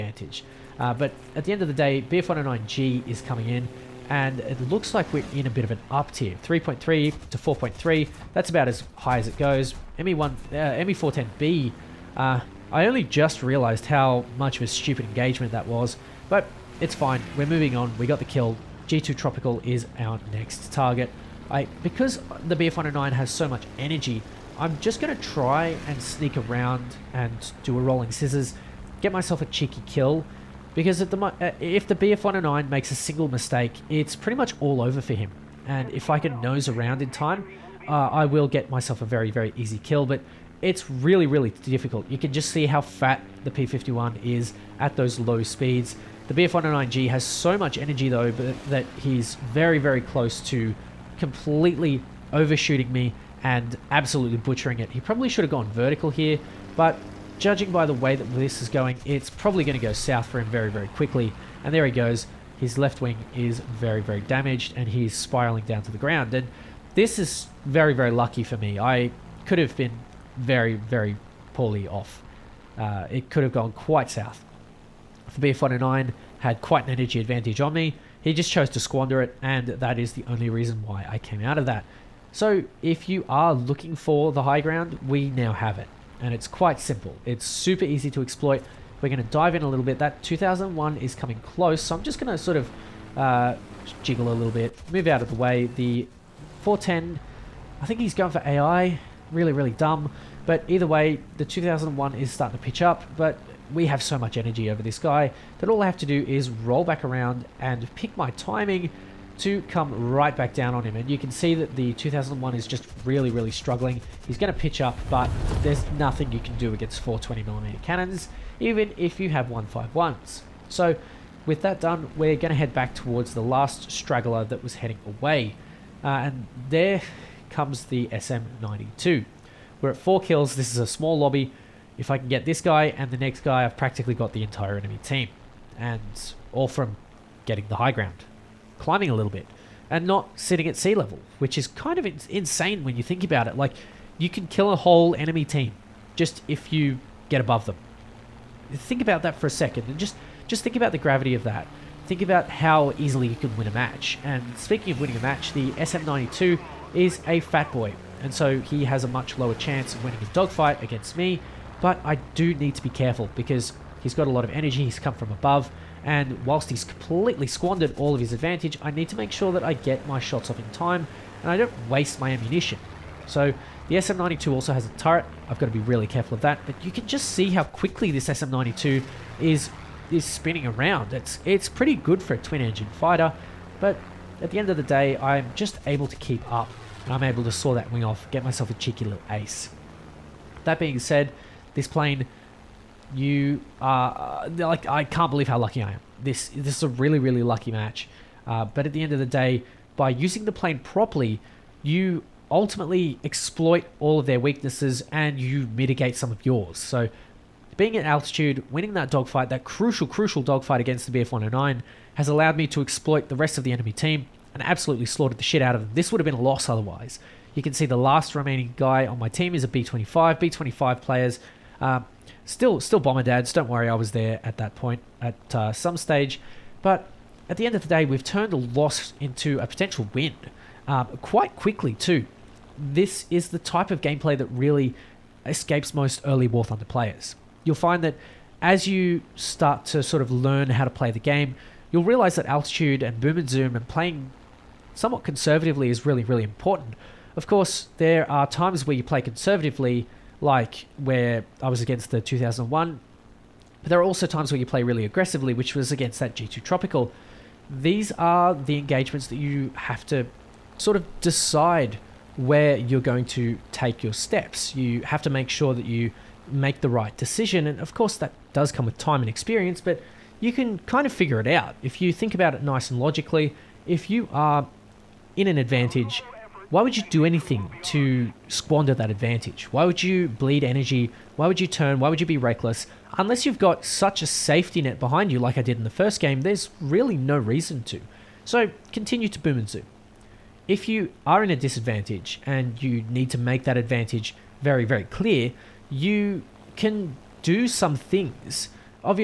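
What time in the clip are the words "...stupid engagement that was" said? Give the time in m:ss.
0:14.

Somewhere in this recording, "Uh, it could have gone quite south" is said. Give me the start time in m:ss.
1:12.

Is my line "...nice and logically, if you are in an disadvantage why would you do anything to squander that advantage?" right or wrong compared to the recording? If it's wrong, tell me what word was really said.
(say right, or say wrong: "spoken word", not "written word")
wrong: "advantage", not "disadvantage".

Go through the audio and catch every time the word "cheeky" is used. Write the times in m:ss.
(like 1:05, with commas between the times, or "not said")
0:29, 3:08.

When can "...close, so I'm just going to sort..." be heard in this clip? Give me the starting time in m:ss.
1:31.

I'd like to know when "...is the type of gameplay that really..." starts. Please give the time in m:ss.
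3:53.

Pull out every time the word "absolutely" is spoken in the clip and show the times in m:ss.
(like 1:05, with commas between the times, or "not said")
0:53, 3:34.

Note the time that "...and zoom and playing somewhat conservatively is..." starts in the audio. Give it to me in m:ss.
4:03.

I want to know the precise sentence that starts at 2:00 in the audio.
So with that done, we're going to head back towards the last straggler that was heading away.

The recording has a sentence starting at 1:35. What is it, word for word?
The 410, I think he's going for AI.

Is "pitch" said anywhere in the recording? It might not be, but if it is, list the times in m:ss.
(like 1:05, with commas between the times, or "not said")
1:42, 1:54.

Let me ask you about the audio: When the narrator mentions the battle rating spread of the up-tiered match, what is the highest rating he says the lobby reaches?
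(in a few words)
4.3.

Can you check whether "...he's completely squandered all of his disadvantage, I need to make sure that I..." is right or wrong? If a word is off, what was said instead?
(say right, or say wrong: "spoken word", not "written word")
wrong: "advantage", not "disadvantage".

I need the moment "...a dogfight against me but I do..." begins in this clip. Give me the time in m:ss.
2:40.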